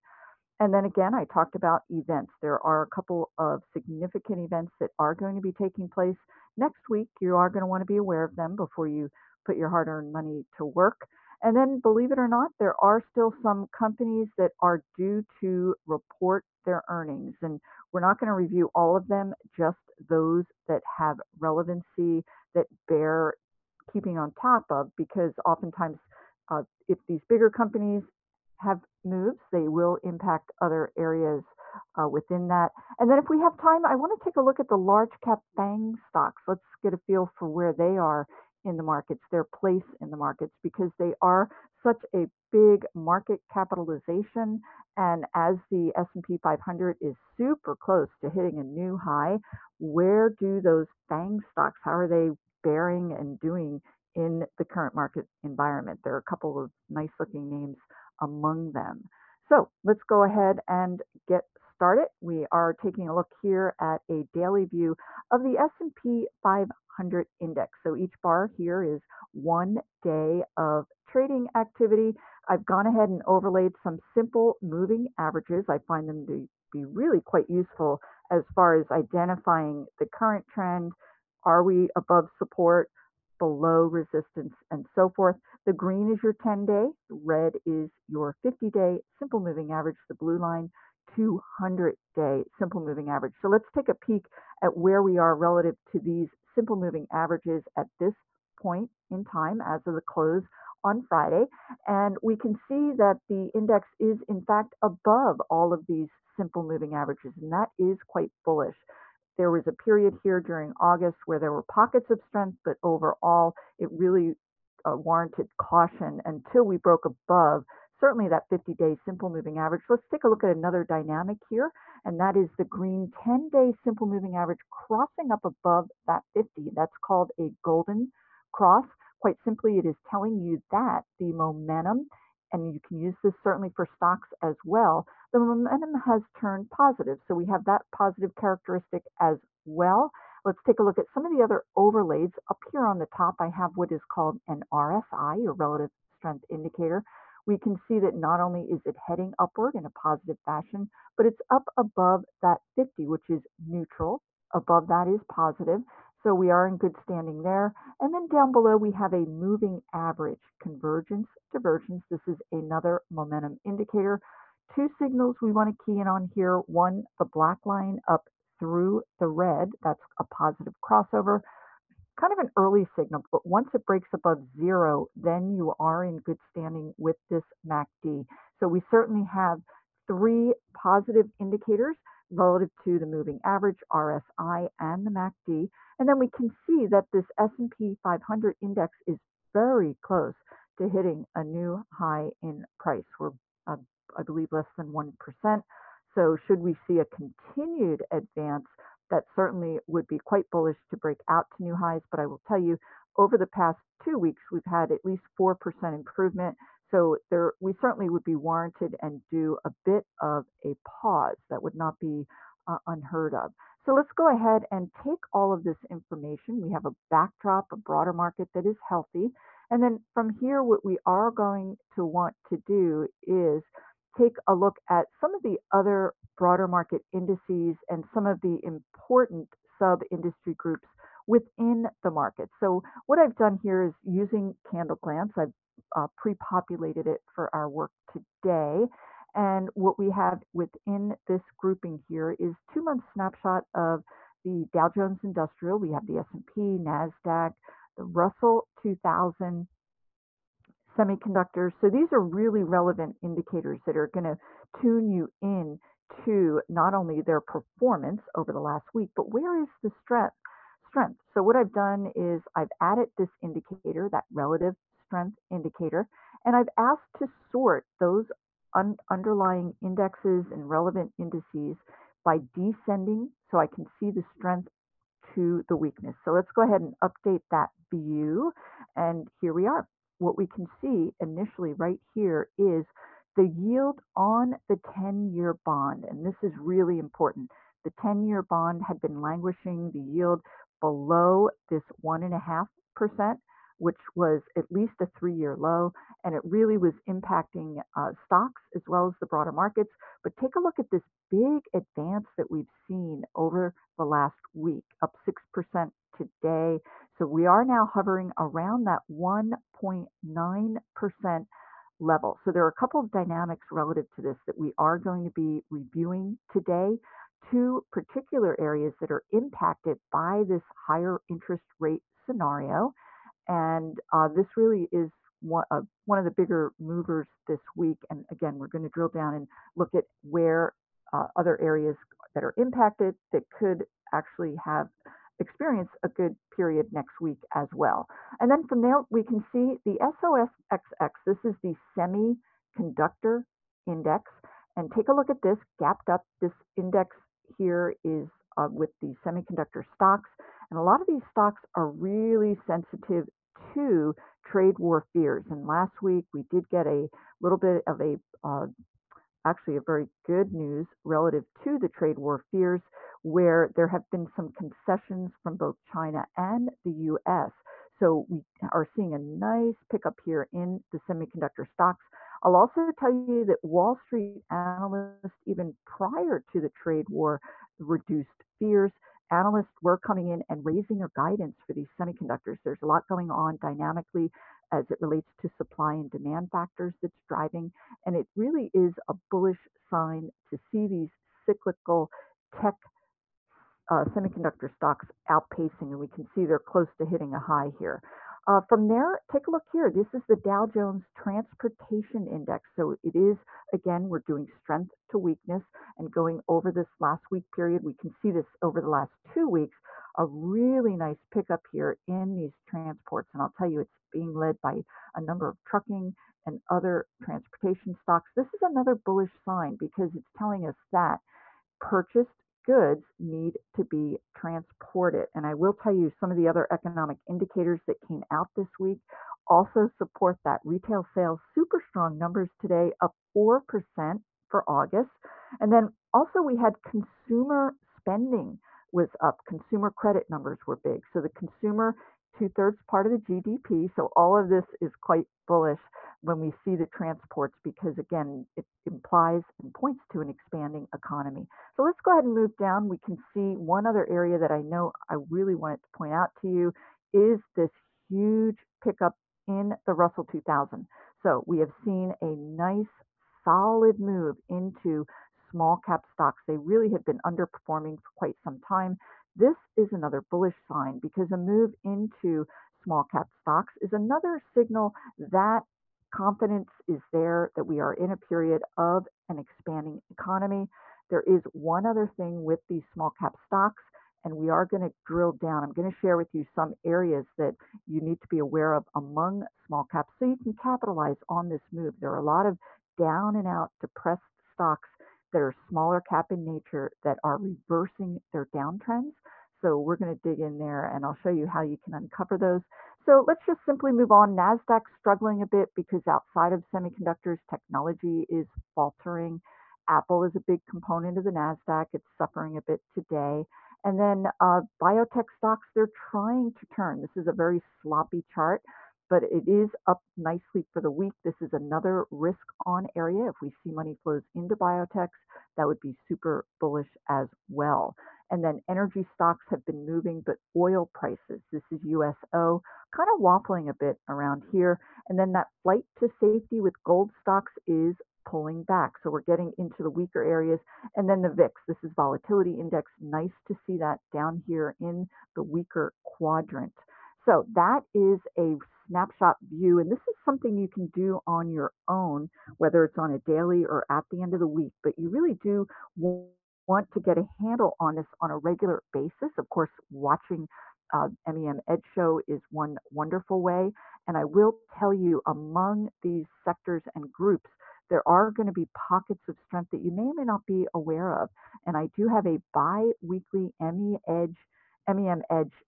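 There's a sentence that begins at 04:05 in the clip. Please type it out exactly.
We have the S&P, NASDAQ, the Russell 2000, semiconductors.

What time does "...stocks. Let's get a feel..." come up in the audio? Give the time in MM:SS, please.
00:35.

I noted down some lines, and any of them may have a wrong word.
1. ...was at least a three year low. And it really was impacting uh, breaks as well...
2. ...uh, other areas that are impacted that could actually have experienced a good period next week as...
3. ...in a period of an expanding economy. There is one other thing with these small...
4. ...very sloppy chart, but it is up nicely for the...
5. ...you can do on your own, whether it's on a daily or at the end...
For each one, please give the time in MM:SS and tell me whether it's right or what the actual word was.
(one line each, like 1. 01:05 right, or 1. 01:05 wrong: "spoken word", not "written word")
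1. 04:54 wrong: "stocks", not "breaks"
2. 05:31 right
3. 07:57 right
4. 08:37 right
5. 09:10 right.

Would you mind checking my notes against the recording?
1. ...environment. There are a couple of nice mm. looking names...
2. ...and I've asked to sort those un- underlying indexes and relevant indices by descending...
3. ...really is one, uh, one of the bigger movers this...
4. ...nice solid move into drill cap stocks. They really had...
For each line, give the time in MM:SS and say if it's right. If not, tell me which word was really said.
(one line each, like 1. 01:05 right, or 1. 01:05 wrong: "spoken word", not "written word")
1. 00:55 right
2. 04:26 right
3. 05:24 right
4. 07:42 wrong: "small", not "drill".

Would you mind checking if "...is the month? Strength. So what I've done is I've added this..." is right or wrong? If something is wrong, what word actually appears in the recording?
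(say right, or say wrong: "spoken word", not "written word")
wrong: "strength", not "month".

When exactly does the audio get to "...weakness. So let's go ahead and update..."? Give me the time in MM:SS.
04:35.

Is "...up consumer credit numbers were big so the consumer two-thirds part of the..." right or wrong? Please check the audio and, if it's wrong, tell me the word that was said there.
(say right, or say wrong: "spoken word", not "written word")
right.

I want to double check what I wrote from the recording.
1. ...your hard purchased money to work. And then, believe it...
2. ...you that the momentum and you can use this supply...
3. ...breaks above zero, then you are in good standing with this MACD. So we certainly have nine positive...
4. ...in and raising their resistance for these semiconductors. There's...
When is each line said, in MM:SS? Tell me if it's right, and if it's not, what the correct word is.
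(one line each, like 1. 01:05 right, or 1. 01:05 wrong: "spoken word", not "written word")
1. 00:09 wrong: "earned", not "purchased"
2. 02:10 wrong: "certainly", not "supply"
3. 02:53 wrong: "three", not "nine"
4. 06:20 wrong: "guidance", not "resistance".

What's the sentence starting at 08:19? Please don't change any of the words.
So we're going to dig in there and I'll show you how you can uncover those.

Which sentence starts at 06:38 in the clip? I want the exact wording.
Uh, from there, take a look here.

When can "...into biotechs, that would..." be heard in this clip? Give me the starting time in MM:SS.
08:44.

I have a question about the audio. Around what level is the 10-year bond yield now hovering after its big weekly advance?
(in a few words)
1.9%.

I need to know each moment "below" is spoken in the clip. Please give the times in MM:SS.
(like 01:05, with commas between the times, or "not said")
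01:23, 02:38, 04:50.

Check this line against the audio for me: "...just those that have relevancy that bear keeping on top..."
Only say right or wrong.
right.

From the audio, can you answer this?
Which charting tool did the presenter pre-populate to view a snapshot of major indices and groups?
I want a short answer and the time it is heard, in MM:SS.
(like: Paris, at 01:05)
CandleGlance, at 03:54.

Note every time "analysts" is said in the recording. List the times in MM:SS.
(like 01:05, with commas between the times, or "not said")
06:14, 06:19.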